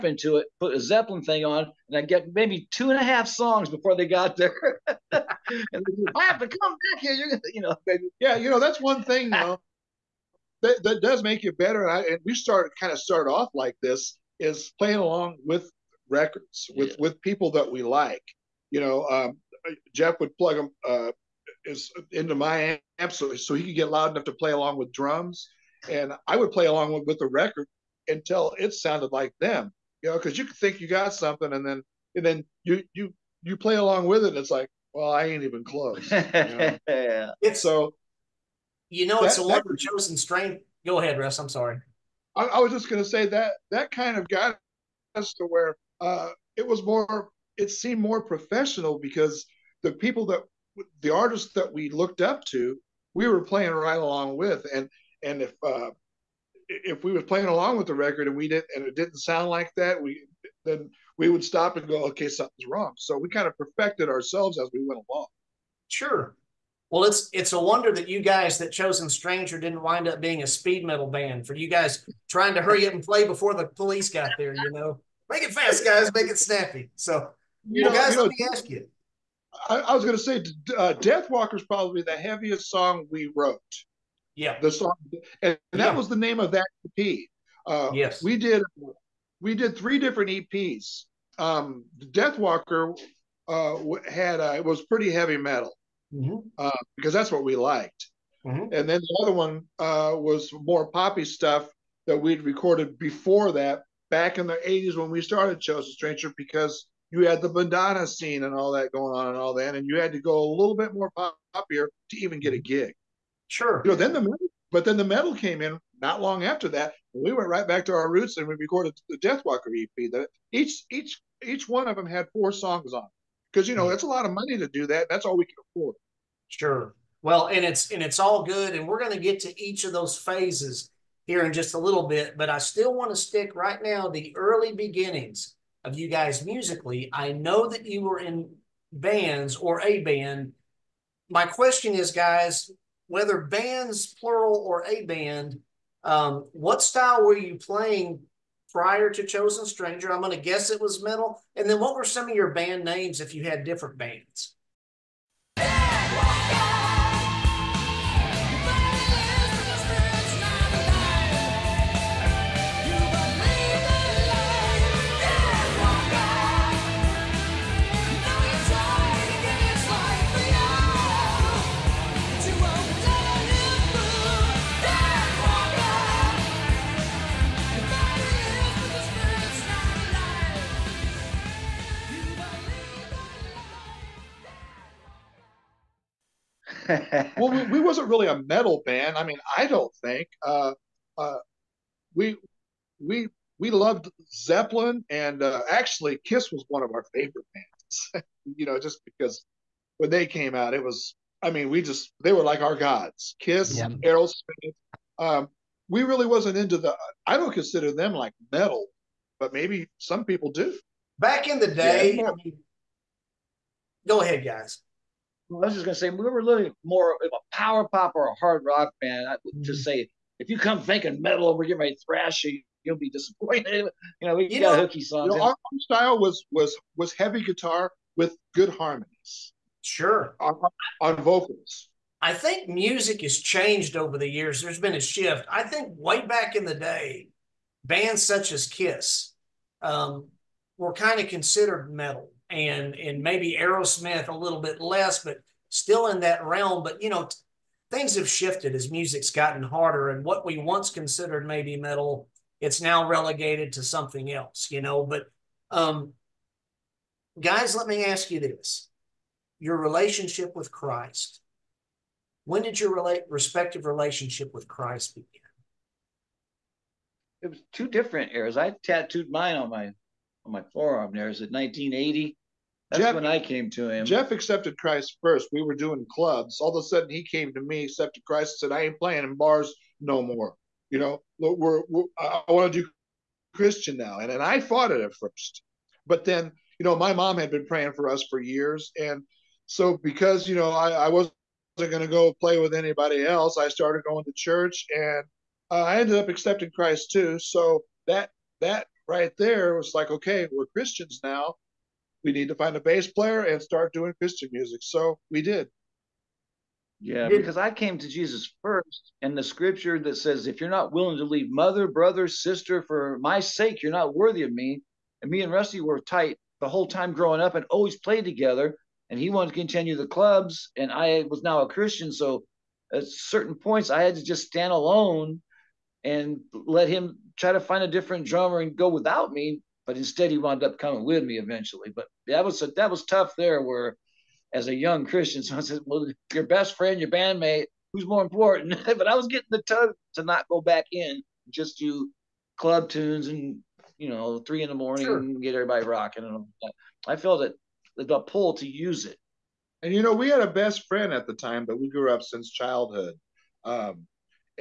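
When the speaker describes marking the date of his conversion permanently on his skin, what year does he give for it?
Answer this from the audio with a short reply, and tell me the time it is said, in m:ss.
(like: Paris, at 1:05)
1980, at 4:31.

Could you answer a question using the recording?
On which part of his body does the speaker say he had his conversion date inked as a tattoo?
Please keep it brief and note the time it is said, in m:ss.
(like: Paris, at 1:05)
Forearm, at 4:30.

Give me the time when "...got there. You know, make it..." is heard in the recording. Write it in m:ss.
1:14.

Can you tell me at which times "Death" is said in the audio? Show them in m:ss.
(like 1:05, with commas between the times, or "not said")
1:20, 1:32, 1:59.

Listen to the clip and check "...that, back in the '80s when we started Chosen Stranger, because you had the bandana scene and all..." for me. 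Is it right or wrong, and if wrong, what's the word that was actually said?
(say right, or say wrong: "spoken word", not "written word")
right.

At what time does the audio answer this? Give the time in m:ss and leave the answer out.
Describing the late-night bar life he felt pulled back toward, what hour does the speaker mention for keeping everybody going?
5:44.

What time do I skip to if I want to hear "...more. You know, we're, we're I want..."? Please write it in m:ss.
4:40.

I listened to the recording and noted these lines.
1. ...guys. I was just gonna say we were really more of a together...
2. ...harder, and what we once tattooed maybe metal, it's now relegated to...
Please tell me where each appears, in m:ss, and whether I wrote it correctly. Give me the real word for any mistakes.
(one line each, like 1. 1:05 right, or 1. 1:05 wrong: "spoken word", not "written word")
1. 3:34 wrong: "power", not "together"
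2. 4:09 wrong: "considered", not "tattooed".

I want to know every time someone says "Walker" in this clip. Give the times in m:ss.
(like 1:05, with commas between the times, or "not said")
1:21, 1:32, 1:59.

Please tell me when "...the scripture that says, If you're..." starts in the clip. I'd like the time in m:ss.
5:09.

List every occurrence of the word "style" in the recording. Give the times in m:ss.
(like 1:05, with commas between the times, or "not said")
2:26, 3:45.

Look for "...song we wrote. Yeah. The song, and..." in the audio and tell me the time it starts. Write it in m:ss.
1:22.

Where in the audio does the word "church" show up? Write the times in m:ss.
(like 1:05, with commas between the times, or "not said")
4:54.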